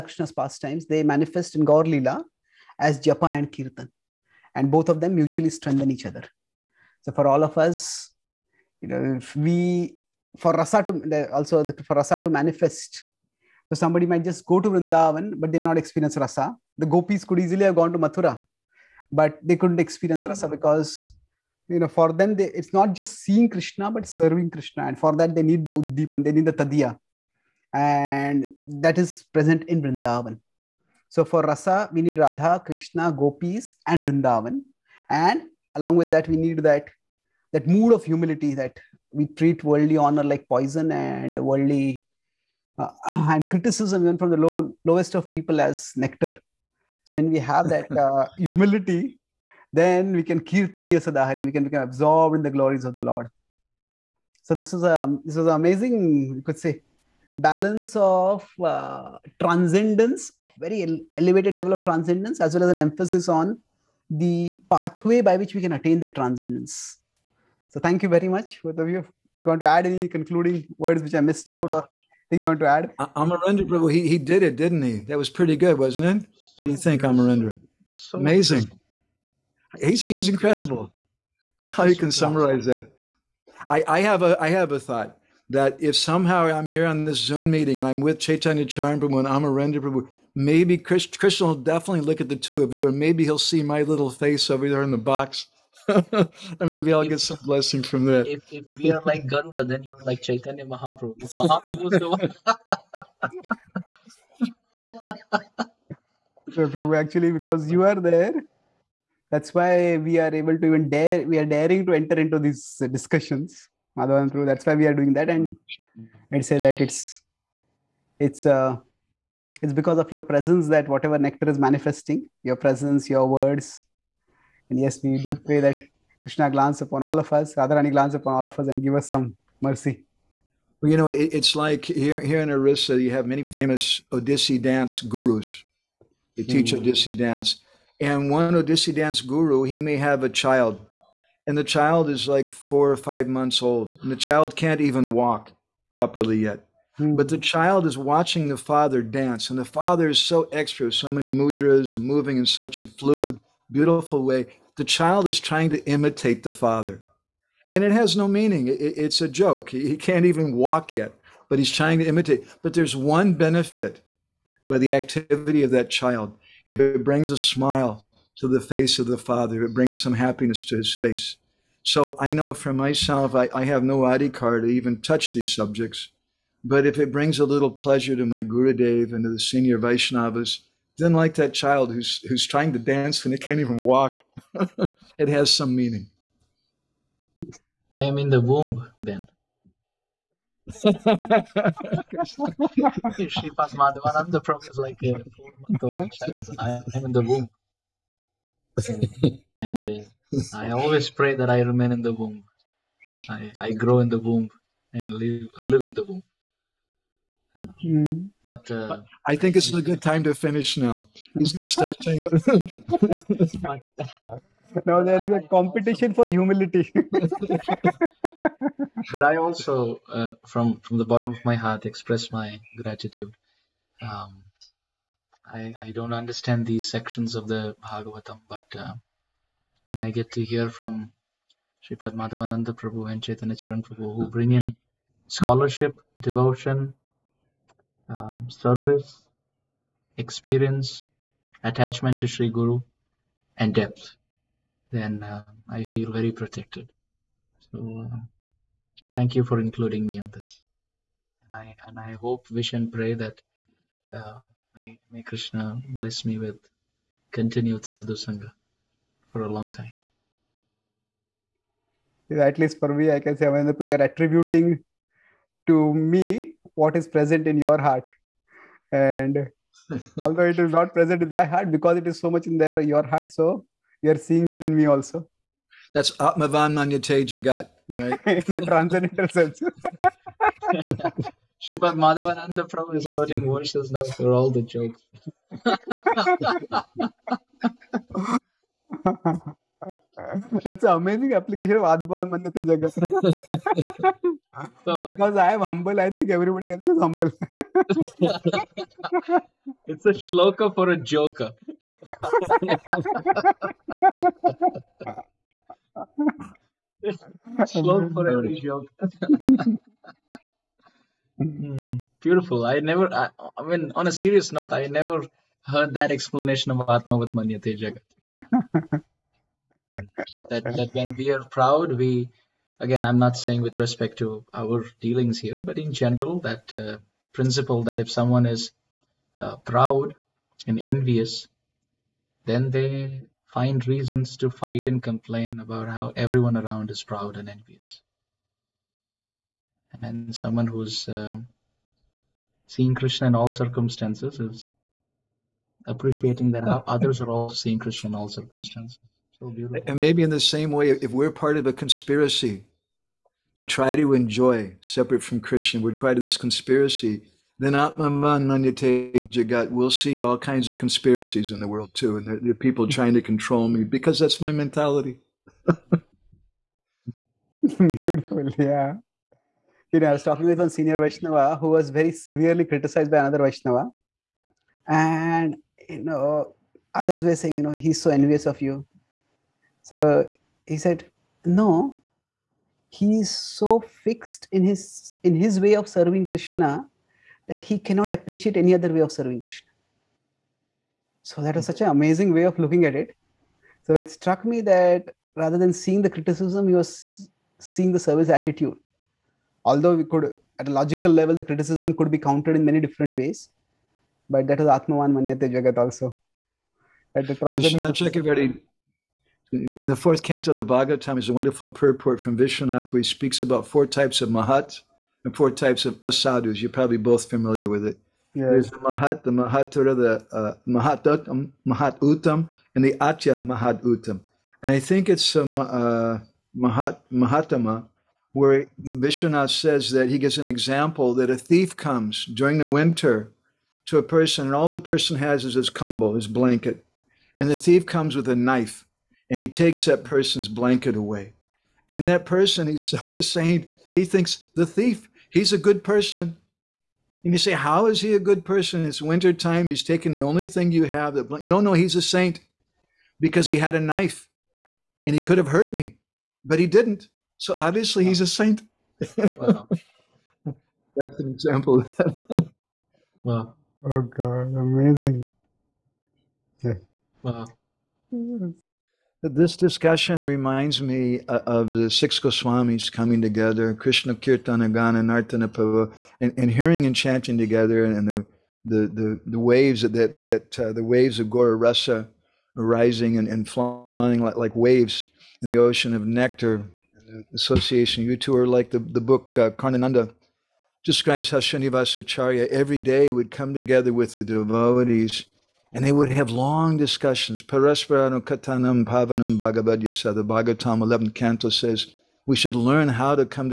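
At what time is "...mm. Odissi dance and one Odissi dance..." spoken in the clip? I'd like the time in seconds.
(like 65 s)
136 s.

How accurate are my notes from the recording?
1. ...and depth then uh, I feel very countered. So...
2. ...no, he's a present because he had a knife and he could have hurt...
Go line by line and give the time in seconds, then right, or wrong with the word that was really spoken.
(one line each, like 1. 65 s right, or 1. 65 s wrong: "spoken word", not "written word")
1. 243 s wrong: "protected", not "countered"
2. 451 s wrong: "saint", not "present".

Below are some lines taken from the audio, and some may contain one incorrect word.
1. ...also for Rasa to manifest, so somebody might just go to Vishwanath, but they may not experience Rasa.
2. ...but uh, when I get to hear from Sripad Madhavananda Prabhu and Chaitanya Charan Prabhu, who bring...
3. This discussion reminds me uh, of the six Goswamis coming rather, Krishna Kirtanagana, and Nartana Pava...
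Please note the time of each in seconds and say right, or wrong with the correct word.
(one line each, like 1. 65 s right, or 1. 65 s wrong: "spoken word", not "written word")
1. 11 s wrong: "Vrindavan", not "Vishwanath"
2. 228 s right
3. 469 s wrong: "together", not "rather".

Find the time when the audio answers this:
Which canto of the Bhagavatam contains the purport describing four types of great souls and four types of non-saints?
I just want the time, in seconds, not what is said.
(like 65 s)
409 s.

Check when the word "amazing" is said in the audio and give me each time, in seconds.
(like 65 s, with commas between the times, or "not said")
55 s, 78 s, 290 s, 391 s, 464 s.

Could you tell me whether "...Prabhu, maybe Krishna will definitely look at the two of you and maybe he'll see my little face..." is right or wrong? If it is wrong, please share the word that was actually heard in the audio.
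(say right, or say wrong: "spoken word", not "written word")
right.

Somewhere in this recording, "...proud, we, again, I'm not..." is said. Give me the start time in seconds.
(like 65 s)
321 s.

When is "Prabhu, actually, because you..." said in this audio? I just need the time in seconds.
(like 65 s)
106 s.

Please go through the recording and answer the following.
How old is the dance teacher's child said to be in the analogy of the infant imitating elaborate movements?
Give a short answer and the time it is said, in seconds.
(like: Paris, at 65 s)
4 or 5 months, at 142 s.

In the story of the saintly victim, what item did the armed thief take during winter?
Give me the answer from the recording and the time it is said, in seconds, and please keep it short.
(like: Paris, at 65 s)
His blanket, at 436 s.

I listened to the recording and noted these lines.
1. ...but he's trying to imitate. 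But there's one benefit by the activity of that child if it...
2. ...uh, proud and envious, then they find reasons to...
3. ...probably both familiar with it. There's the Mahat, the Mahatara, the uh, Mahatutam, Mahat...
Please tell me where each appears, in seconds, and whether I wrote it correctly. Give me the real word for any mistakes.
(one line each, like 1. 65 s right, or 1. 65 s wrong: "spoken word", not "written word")
1. 161 s right
2. 329 s right
3. 416 s right.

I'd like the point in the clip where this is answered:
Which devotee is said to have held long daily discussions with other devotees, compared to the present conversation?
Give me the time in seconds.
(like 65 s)
491 s.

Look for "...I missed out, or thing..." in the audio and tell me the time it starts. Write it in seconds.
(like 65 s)
71 s.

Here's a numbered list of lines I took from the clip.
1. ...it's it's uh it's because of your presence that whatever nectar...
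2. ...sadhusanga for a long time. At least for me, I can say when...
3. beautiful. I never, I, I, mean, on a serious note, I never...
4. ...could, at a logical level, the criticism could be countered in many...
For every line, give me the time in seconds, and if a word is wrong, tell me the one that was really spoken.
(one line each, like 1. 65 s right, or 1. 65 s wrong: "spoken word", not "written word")
1. 116 s right
2. 257 s right
3. 312 s right
4. 400 s right.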